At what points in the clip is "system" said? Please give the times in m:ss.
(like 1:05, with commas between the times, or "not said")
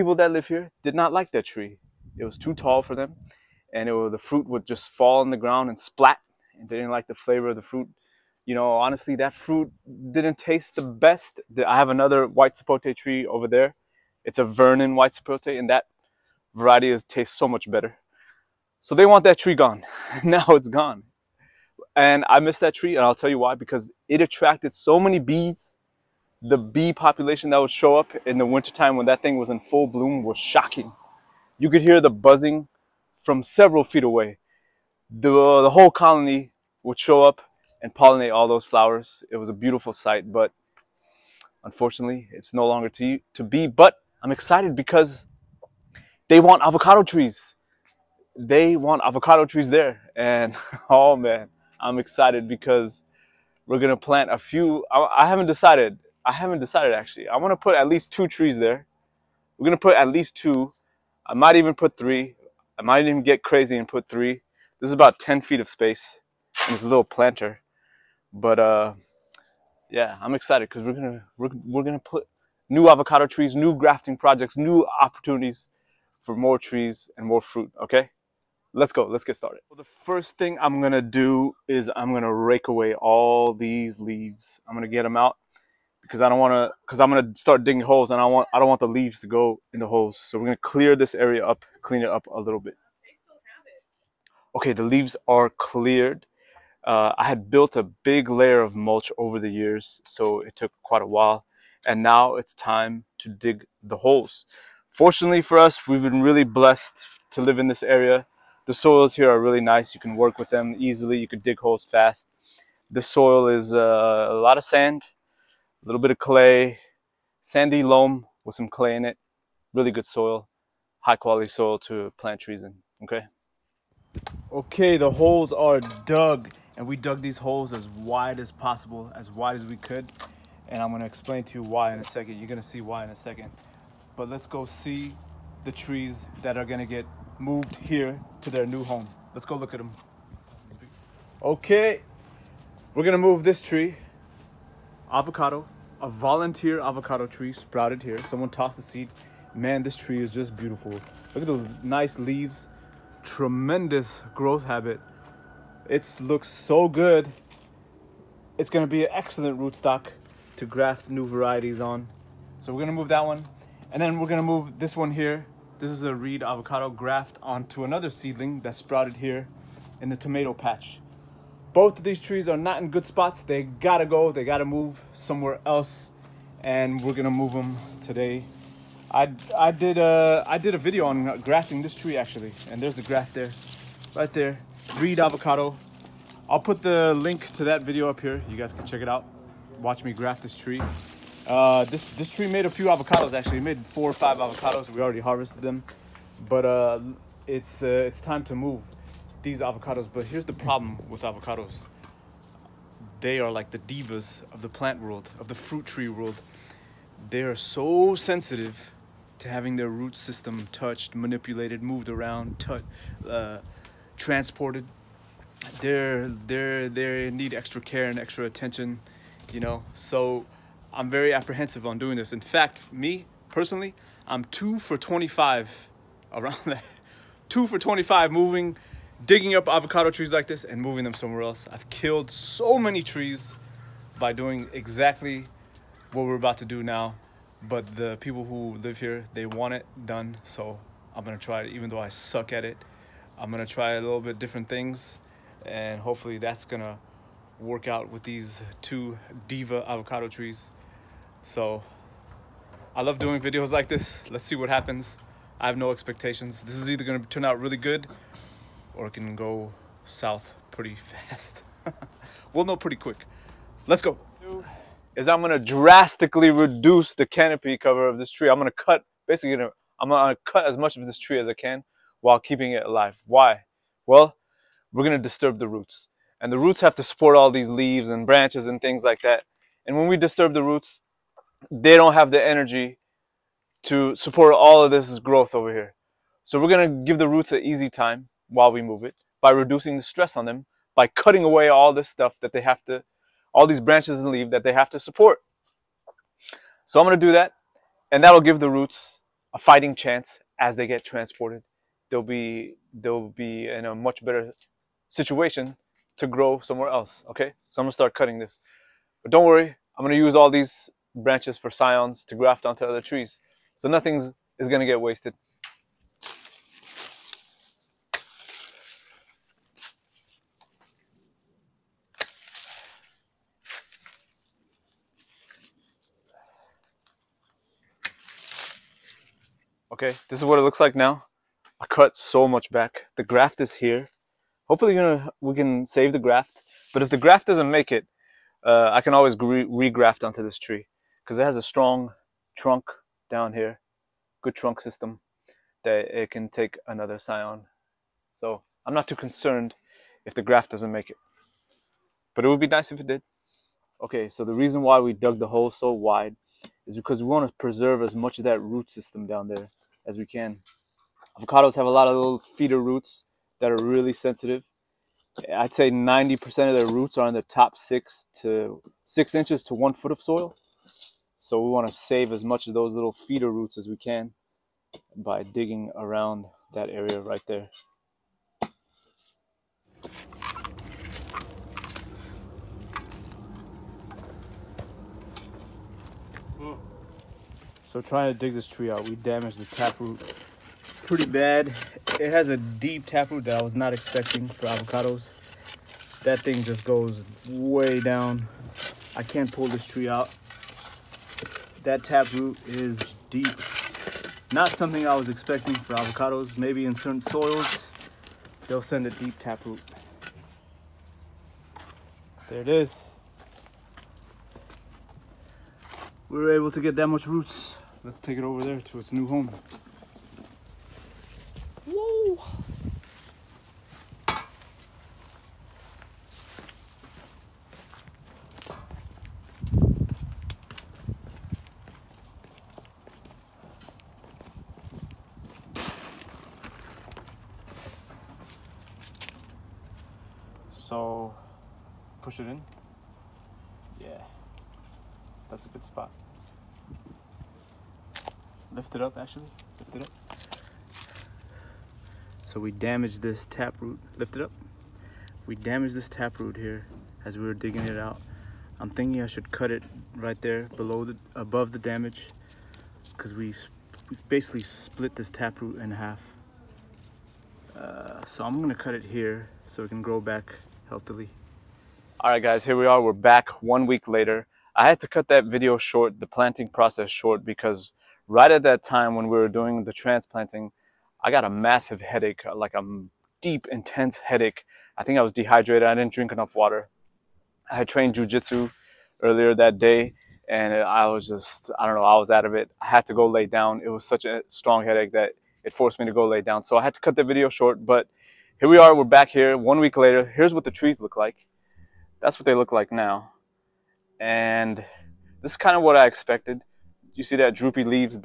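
3:30, 5:44, 5:58.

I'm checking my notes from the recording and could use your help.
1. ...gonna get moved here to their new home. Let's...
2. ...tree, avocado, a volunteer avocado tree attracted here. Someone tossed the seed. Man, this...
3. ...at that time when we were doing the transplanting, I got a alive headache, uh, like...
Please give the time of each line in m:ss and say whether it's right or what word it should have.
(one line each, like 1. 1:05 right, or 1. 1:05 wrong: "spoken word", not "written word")
1. 2:16 right
2. 2:23 wrong: "sprouted", not "attracted"
3. 7:58 wrong: "massive", not "alive".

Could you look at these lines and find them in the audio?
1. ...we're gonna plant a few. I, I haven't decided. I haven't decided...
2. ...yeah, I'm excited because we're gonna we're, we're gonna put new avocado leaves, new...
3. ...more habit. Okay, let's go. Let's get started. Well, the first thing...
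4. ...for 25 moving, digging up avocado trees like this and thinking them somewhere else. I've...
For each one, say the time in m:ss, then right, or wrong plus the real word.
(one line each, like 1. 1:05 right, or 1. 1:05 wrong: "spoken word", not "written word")
1. 0:53 right
2. 1:09 wrong: "trees", not "leaves"
3. 1:17 wrong: "fruit", not "habit"
4. 3:47 wrong: "moving", not "thinking".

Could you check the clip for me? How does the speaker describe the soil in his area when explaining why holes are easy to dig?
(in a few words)
sandy loam.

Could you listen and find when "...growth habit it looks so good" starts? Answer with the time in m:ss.
2:34.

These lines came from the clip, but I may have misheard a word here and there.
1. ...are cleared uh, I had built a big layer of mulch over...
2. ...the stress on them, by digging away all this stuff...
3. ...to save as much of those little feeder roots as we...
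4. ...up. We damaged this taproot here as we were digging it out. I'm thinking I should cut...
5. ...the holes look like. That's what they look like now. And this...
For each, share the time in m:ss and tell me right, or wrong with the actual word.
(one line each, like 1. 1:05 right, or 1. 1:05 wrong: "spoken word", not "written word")
1. 1:35 right
2. 4:49 wrong: "cutting", not "digging"
3. 6:11 right
4. 7:34 right
5. 8:20 wrong: "trees", not "holes".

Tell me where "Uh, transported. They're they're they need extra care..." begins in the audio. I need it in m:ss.
3:33.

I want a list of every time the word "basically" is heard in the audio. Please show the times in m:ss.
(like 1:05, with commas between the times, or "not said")
4:29, 7:44.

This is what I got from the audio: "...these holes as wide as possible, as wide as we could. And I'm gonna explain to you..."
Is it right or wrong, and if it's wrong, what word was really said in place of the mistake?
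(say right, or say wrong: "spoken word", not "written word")
right.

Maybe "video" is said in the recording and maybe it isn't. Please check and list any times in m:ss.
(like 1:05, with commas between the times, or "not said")
3:00, 3:07, 4:13, 7:55, 8:17.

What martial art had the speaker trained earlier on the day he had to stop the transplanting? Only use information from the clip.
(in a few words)
jujitsu.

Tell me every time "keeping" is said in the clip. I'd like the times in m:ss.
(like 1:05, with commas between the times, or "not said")
4:32.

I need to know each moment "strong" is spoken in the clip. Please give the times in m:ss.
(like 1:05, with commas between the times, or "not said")
5:41, 8:14.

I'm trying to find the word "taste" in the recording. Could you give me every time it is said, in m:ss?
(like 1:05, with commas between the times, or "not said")
0:10, 0:17.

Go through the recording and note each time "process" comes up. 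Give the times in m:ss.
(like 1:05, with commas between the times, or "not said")
7:56.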